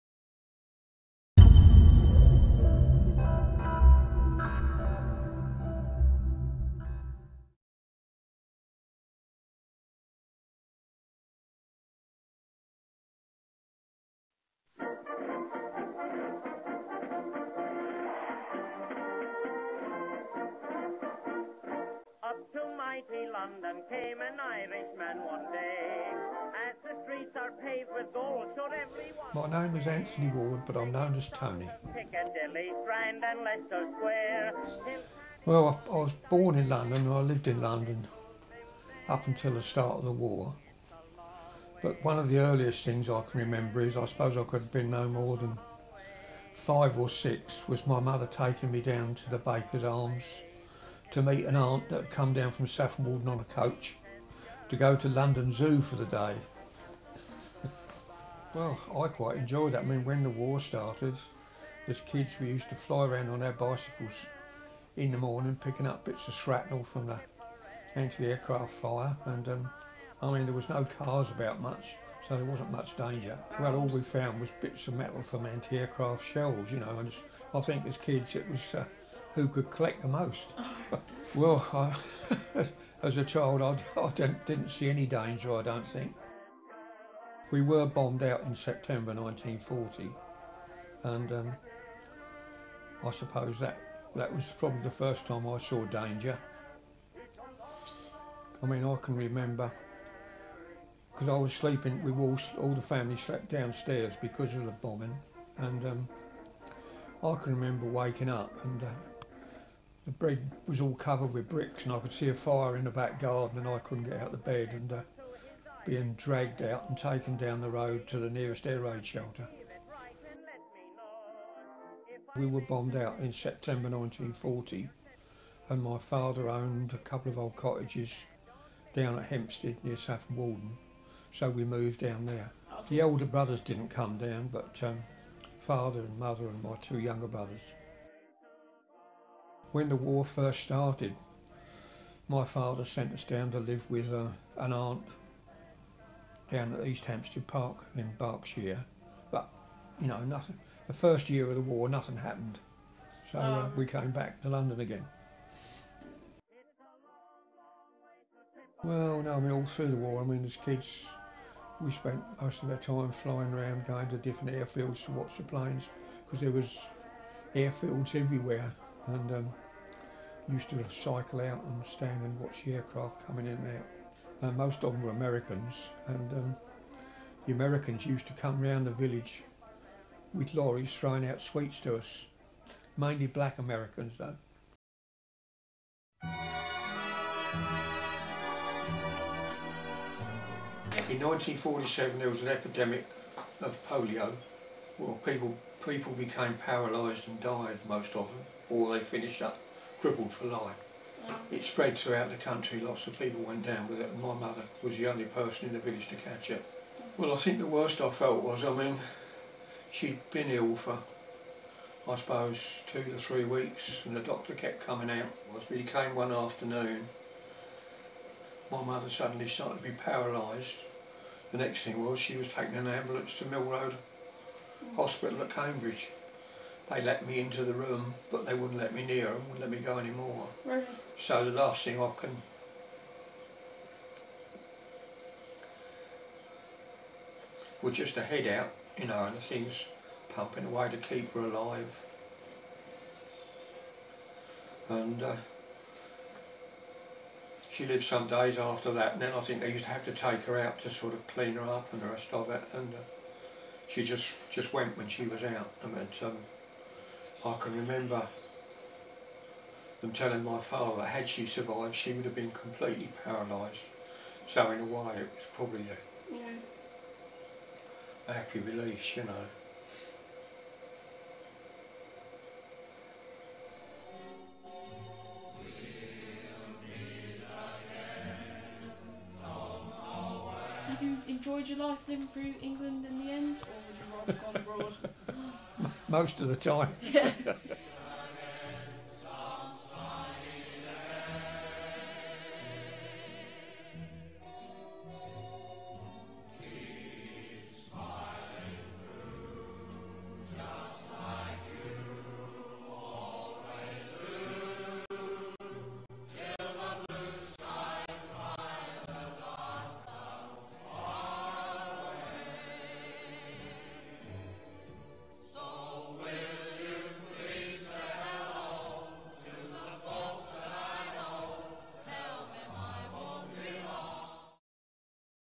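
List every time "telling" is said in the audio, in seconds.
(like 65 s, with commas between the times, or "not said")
260 s.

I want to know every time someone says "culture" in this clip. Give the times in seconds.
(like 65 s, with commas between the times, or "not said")
not said.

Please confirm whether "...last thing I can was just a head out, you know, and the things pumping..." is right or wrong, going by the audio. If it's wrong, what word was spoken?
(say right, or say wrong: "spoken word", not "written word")
right.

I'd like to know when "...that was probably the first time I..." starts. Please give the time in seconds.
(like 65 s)
94 s.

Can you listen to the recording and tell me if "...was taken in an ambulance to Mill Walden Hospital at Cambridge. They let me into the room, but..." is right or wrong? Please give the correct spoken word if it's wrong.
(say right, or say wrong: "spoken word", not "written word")
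wrong: "Road", not "Walden".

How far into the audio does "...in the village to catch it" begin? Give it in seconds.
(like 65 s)
205 s.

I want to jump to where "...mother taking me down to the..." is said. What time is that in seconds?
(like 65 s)
47 s.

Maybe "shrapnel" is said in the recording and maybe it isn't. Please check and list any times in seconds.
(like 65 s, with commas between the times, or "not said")
66 s.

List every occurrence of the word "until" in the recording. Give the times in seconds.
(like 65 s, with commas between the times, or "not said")
39 s.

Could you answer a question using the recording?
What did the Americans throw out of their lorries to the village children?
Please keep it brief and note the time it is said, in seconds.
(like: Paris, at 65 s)
Sweets, at 181 s.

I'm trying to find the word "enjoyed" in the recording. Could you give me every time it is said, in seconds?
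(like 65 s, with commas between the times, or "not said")
59 s, 281 s.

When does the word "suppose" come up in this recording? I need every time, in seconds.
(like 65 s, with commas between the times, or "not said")
44 s, 93 s, 212 s.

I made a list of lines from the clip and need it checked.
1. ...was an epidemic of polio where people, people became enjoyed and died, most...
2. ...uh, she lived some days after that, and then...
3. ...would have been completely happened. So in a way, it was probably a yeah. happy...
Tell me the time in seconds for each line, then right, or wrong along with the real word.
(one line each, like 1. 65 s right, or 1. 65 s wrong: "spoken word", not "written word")
1. 192 s wrong: "paralysed", not "enjoyed"
2. 245 s right
3. 262 s wrong: "paralysed", not "happened".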